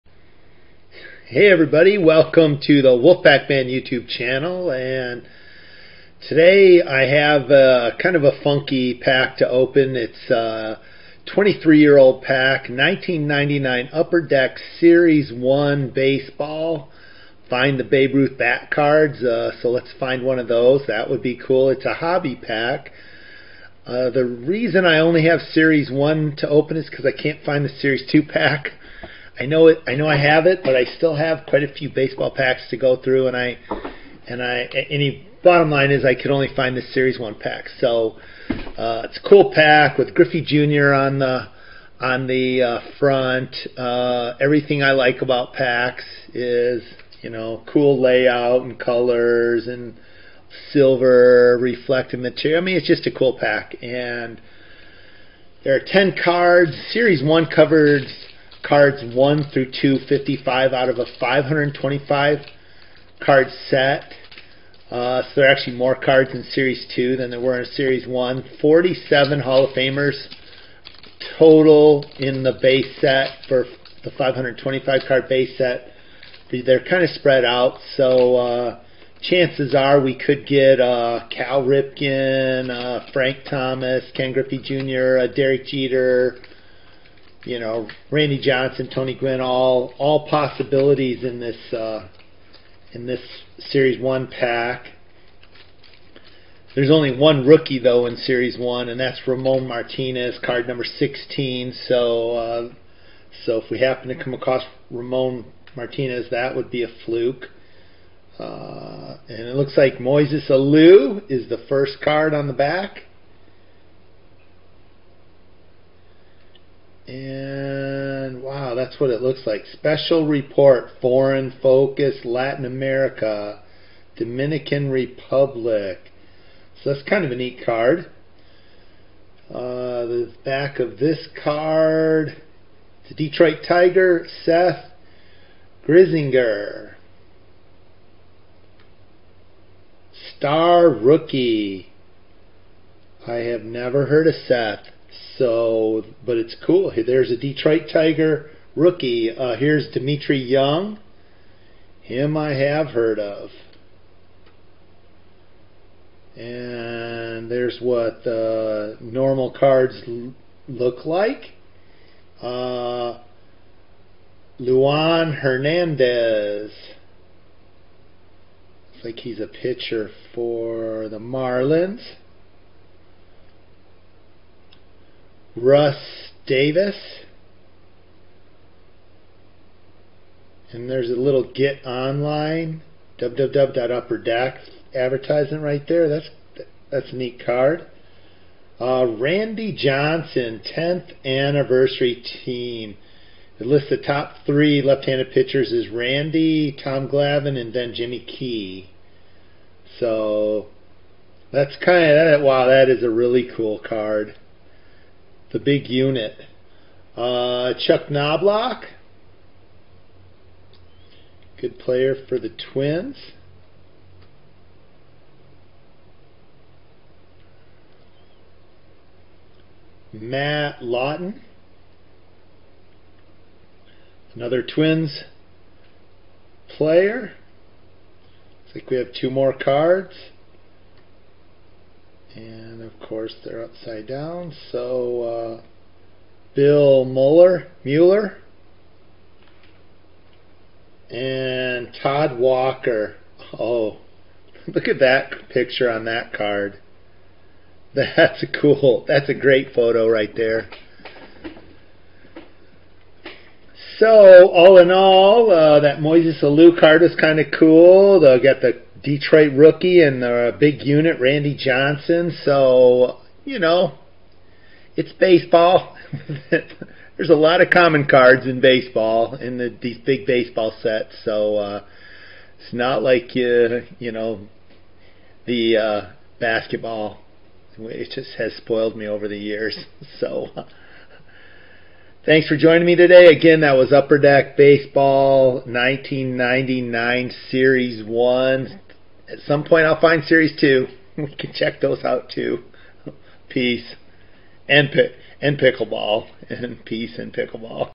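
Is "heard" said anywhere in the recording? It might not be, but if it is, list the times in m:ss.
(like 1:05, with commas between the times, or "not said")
2:24, 2:32.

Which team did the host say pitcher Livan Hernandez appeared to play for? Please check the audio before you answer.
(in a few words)
Marlins.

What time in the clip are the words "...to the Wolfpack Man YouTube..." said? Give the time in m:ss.
0:02.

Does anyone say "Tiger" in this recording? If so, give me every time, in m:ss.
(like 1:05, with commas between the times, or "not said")
2:13, 2:27.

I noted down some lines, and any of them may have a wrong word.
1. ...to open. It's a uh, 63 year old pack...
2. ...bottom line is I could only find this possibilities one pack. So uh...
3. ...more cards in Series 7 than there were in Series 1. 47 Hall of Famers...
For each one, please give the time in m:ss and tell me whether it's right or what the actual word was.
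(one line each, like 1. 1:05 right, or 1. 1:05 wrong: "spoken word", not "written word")
1. 0:09 wrong: "23", not "63"
2. 0:35 wrong: "series", not "possibilities"
3. 1:05 wrong: "2", not "7".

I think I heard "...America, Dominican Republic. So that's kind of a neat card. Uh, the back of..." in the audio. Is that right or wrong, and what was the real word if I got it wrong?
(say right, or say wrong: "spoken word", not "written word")
right.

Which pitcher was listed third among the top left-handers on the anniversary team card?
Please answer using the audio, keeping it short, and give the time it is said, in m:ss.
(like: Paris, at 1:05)
Jimmy Key, at 3:17.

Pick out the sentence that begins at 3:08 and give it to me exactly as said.
Uh, Randy Johnson, 10th anniversary team.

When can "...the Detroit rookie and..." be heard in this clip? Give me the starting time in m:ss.
4:18.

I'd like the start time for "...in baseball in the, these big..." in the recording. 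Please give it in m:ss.
4:28.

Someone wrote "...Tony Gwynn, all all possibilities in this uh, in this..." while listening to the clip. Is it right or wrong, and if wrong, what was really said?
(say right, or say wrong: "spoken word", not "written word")
right.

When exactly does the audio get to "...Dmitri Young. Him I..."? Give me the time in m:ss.
2:29.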